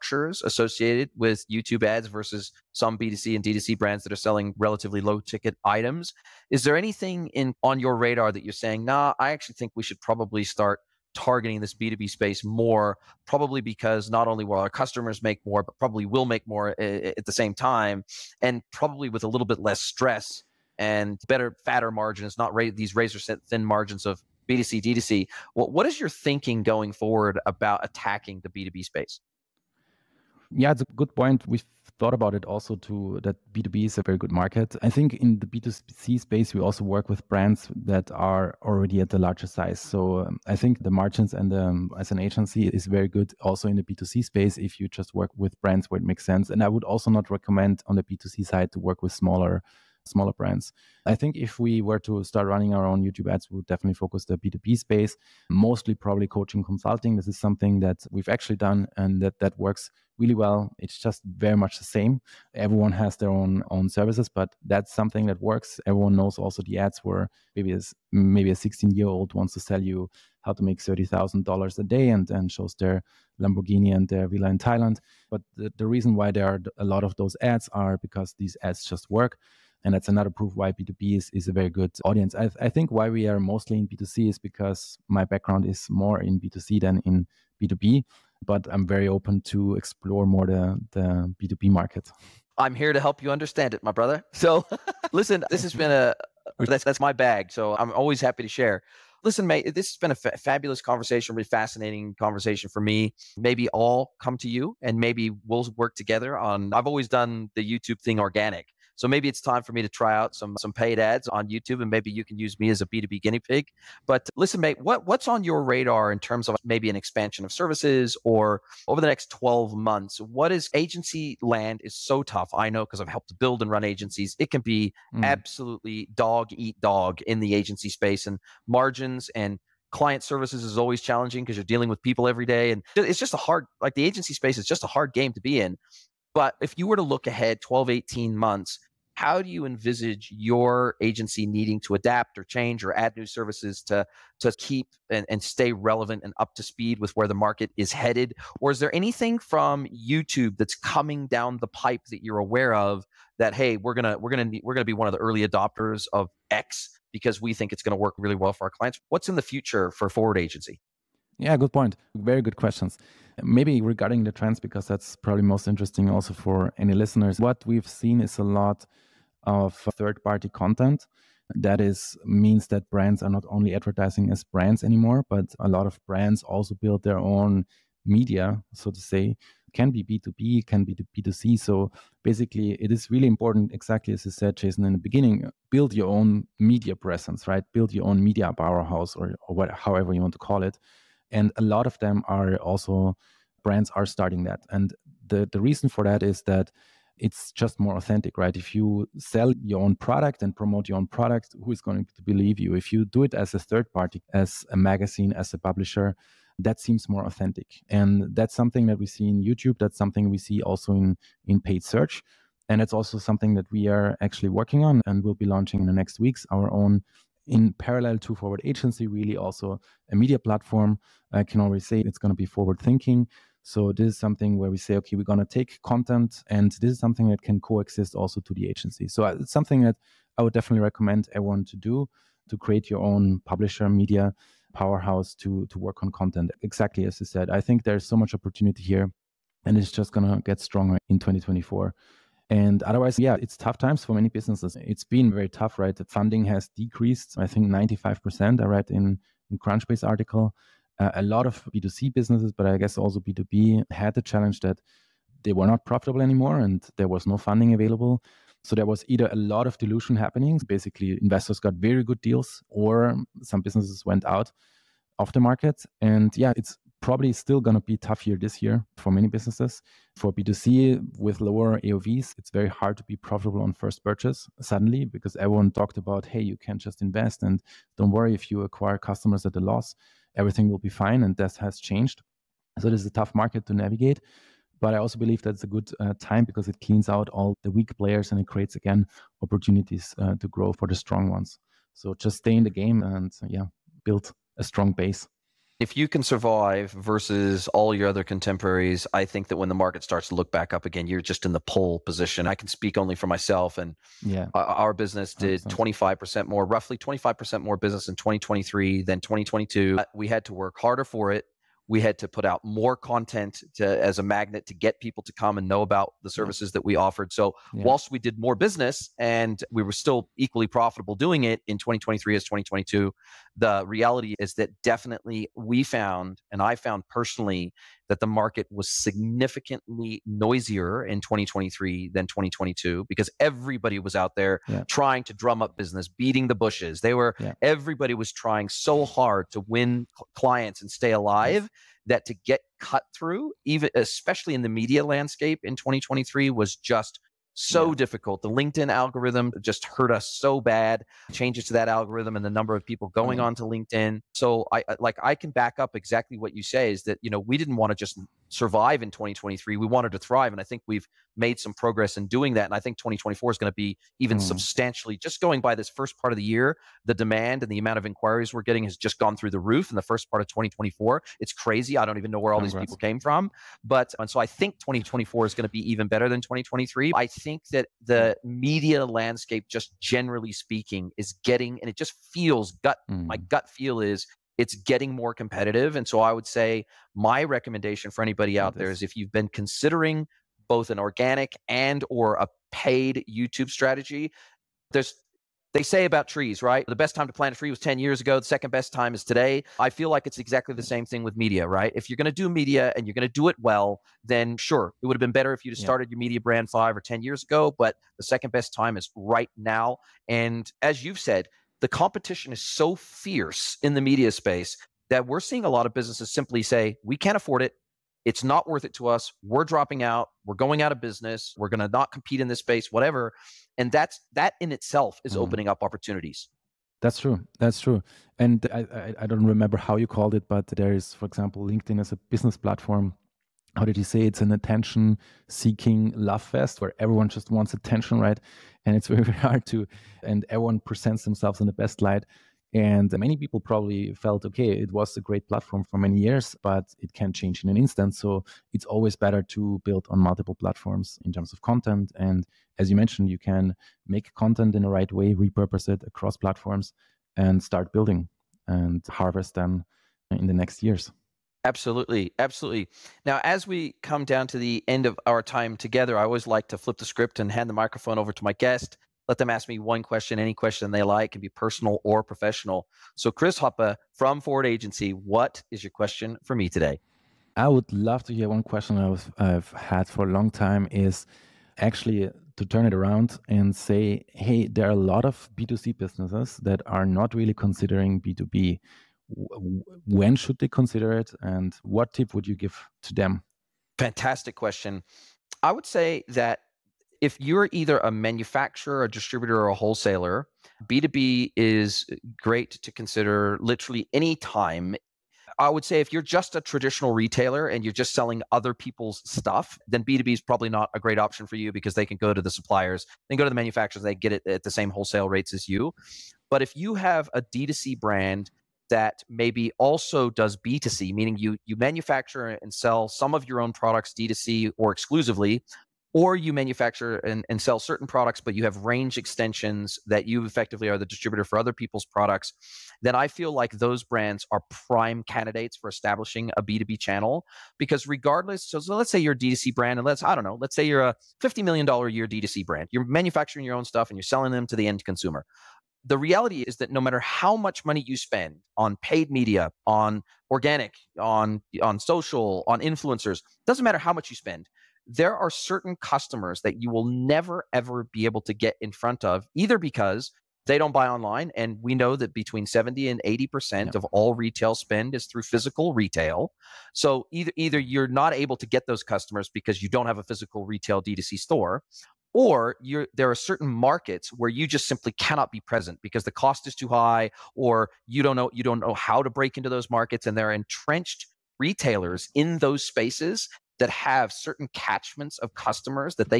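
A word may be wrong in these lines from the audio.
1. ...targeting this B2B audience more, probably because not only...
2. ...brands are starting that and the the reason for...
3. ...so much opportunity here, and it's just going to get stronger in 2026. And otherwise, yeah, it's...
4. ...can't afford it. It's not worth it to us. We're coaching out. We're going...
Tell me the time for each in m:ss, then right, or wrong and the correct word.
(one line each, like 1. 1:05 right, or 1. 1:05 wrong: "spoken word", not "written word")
1. 0:11 wrong: "space", not "audience"
2. 3:13 right
3. 3:58 wrong: "2024", not "2026"
4. 6:57 wrong: "dropping", not "coaching".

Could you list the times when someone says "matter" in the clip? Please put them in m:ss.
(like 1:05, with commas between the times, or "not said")
9:07, 9:13.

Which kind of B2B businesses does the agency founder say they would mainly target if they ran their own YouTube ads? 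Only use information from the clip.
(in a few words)
Coaching consulting.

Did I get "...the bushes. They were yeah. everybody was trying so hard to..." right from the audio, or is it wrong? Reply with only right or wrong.
right.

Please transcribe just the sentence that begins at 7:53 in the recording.
So, Chris Hoppe from Forwrd Agency, what is your question for me today?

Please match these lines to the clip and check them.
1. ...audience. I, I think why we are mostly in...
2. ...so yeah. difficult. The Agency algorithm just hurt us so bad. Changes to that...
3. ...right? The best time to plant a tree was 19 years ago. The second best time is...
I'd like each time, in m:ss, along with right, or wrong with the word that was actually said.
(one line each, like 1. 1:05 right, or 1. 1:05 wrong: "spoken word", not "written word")
1. 1:22 right
2. 5:47 wrong: "LinkedIn", not "Agency"
3. 6:36 wrong: "10", not "19".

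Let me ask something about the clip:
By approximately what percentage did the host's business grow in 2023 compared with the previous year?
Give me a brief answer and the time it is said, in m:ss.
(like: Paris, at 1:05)
25%, at 5:06.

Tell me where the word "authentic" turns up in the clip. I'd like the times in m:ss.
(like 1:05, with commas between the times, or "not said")
3:17, 3:27.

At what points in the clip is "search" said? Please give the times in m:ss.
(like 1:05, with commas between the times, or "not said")
3:31.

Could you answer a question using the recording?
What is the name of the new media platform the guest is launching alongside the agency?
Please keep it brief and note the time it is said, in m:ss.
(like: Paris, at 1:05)
Forward thinking, at 3:42.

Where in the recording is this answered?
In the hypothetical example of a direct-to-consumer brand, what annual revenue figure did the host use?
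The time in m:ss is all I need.
9:01.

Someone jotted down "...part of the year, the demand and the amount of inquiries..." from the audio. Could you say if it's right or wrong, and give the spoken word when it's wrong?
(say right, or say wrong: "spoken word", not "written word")
right.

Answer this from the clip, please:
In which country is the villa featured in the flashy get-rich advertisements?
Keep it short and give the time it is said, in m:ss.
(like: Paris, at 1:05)
Thailand, at 1:14.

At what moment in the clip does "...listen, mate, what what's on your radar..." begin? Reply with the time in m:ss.
1:54.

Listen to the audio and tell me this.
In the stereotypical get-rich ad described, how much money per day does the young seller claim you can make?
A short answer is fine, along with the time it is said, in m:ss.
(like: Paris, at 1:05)
$30,000, at 1:10.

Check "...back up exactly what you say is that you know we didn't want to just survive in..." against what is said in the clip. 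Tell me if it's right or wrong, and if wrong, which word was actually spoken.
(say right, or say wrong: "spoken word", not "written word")
right.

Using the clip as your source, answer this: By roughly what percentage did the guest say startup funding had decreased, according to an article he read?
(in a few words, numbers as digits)
95%.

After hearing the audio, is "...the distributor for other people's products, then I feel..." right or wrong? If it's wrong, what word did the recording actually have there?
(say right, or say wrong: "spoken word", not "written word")
right.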